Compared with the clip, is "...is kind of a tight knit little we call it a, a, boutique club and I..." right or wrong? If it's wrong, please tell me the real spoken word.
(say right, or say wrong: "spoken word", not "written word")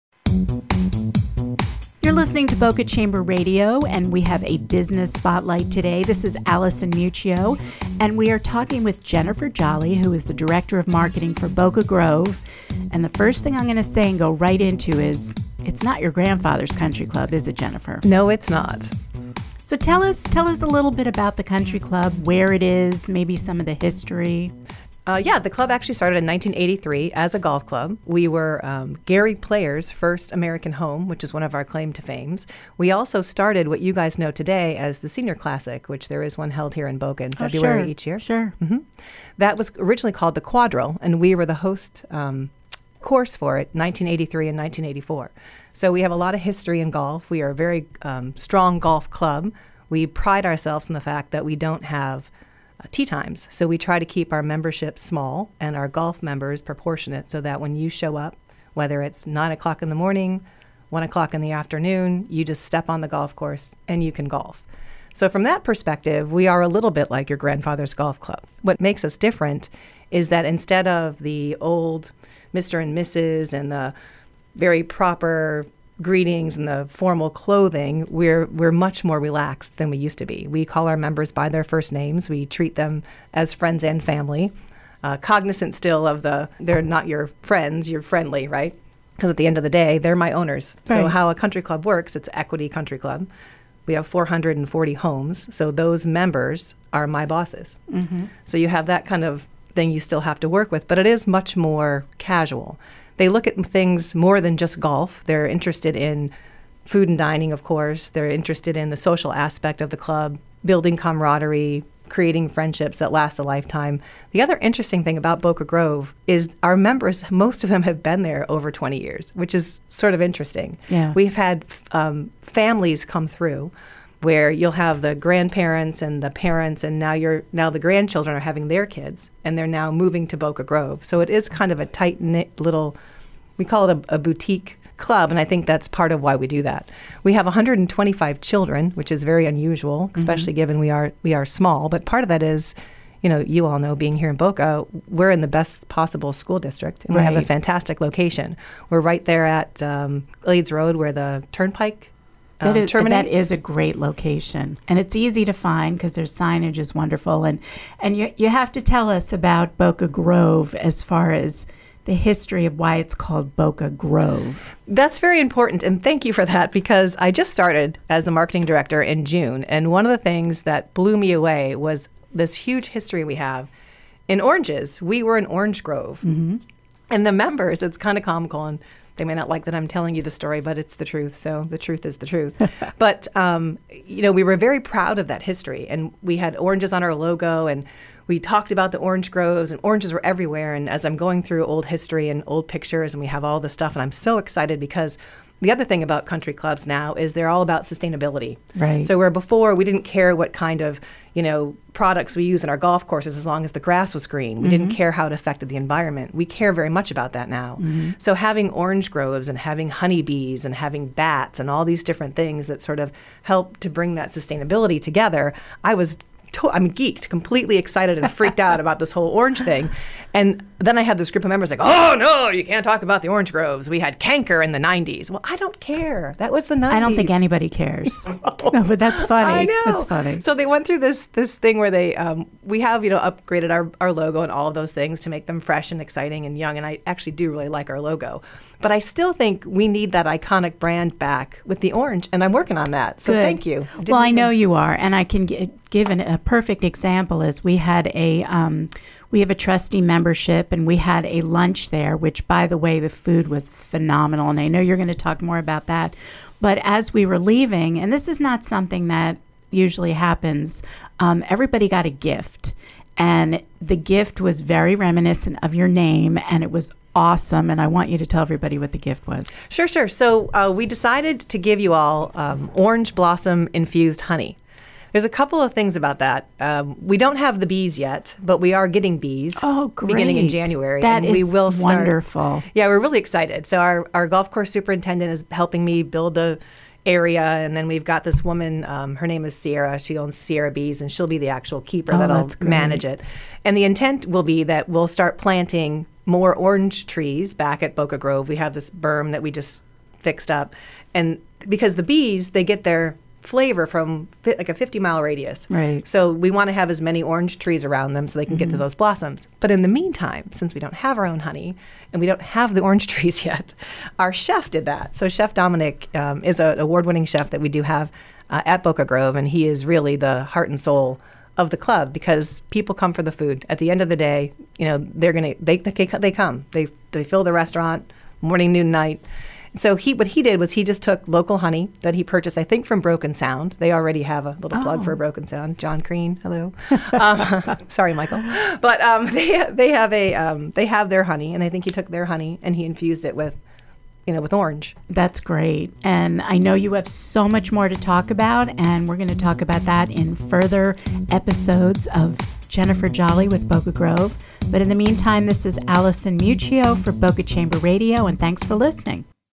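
right.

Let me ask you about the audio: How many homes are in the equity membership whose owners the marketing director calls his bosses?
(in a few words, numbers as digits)
440.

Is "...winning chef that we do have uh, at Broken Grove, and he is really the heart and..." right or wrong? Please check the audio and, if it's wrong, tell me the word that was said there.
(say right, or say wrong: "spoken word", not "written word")
wrong: "Boca", not "Broken".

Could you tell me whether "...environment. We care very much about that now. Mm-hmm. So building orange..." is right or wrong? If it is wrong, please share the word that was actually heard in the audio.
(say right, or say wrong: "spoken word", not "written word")
wrong: "having", not "building".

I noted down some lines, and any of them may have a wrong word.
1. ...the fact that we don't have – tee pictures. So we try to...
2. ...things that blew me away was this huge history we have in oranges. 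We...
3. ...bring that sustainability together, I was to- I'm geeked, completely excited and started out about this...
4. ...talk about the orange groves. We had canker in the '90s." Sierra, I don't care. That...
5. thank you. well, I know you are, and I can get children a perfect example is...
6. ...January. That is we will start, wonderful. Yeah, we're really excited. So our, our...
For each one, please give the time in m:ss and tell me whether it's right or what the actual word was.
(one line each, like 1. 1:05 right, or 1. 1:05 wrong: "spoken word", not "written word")
1. 0:50 wrong: "times", not "pictures"
2. 2:50 right
3. 3:33 wrong: "freaked", not "started"
4. 3:42 wrong: "Well", not "Sierra"
5. 4:03 wrong: "given", not "children"
6. 4:40 right.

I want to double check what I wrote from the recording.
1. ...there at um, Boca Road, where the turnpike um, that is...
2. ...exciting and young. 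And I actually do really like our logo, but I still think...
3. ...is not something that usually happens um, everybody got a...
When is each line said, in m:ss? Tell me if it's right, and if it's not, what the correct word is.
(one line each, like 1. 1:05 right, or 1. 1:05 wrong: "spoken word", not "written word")
1. 2:29 wrong: "Glades", not "Boca"
2. 3:56 right
3. 4:18 right.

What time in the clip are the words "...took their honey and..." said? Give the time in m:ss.
5:41.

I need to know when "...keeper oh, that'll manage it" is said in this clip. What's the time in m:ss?
4:51.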